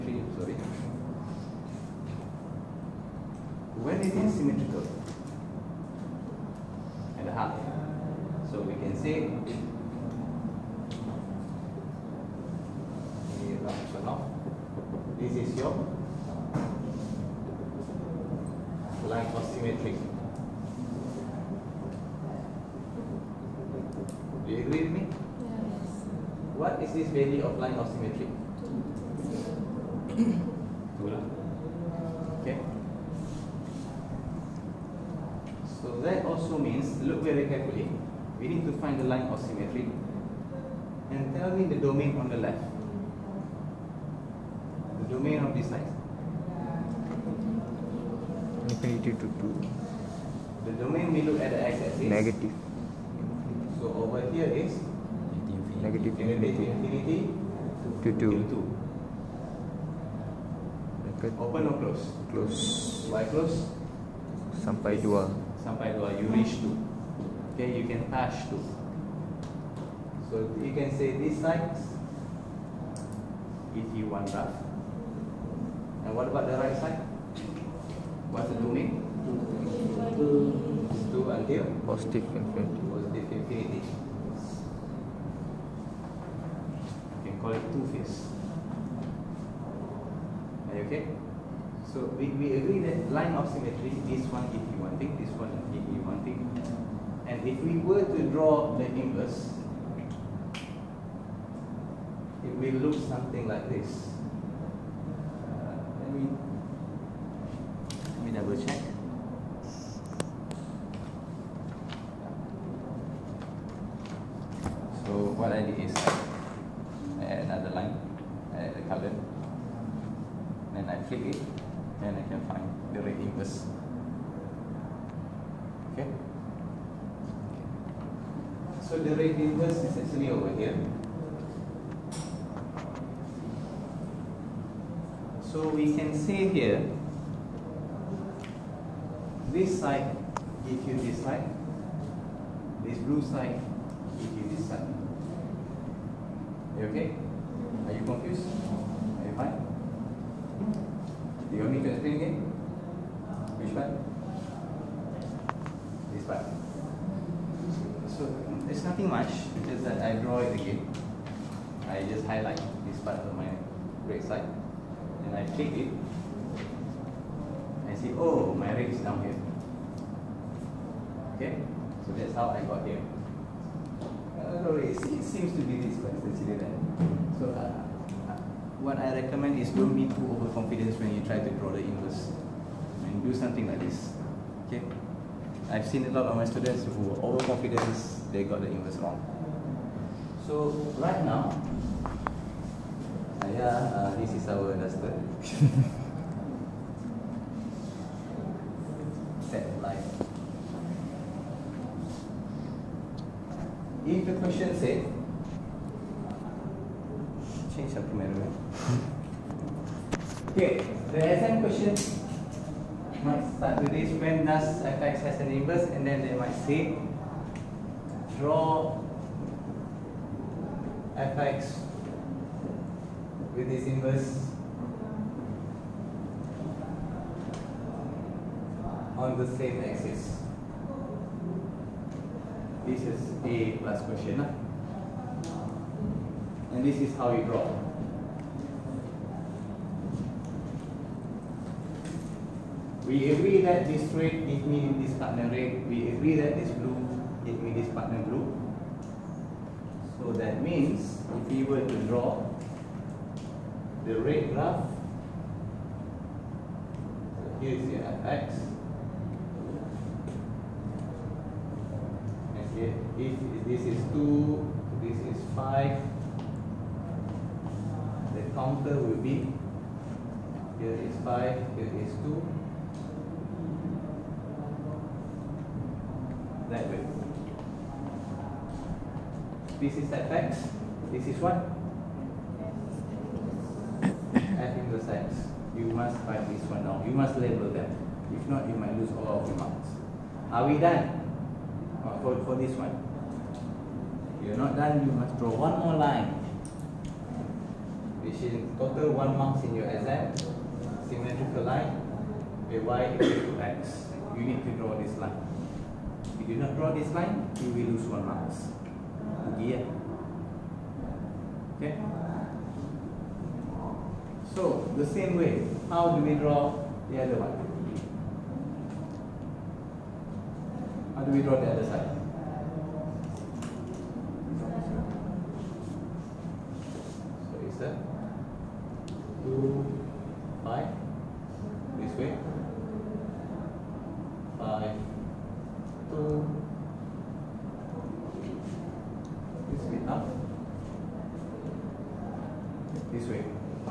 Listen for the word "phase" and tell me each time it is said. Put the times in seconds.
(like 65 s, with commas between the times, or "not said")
87 s.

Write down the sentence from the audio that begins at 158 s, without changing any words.
So it's nothing much, just that I draw it again.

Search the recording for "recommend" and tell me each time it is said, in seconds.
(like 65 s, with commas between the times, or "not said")
179 s.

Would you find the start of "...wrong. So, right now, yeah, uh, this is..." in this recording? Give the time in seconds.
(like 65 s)
188 s.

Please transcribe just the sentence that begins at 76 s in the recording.
And what about the right side?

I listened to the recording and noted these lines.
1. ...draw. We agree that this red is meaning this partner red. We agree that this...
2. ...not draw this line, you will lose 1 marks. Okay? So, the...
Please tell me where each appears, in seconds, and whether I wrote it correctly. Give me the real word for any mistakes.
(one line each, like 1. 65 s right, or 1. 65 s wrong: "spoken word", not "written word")
1. 237 s right
2. 306 s right.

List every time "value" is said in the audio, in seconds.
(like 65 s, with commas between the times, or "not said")
27 s.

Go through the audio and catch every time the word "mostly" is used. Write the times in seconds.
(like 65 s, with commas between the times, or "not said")
not said.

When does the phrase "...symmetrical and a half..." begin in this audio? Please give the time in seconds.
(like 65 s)
4 s.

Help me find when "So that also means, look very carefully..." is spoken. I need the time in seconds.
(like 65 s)
35 s.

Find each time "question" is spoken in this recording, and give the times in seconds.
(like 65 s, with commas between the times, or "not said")
204 s, 211 s, 234 s.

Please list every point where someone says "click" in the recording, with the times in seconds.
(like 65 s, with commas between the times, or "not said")
121 s, 165 s.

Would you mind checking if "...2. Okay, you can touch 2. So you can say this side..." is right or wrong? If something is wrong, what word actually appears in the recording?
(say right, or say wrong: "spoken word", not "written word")
right.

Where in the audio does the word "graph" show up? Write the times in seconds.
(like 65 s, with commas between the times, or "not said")
254 s.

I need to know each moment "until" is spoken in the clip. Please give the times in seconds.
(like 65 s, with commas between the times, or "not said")
81 s.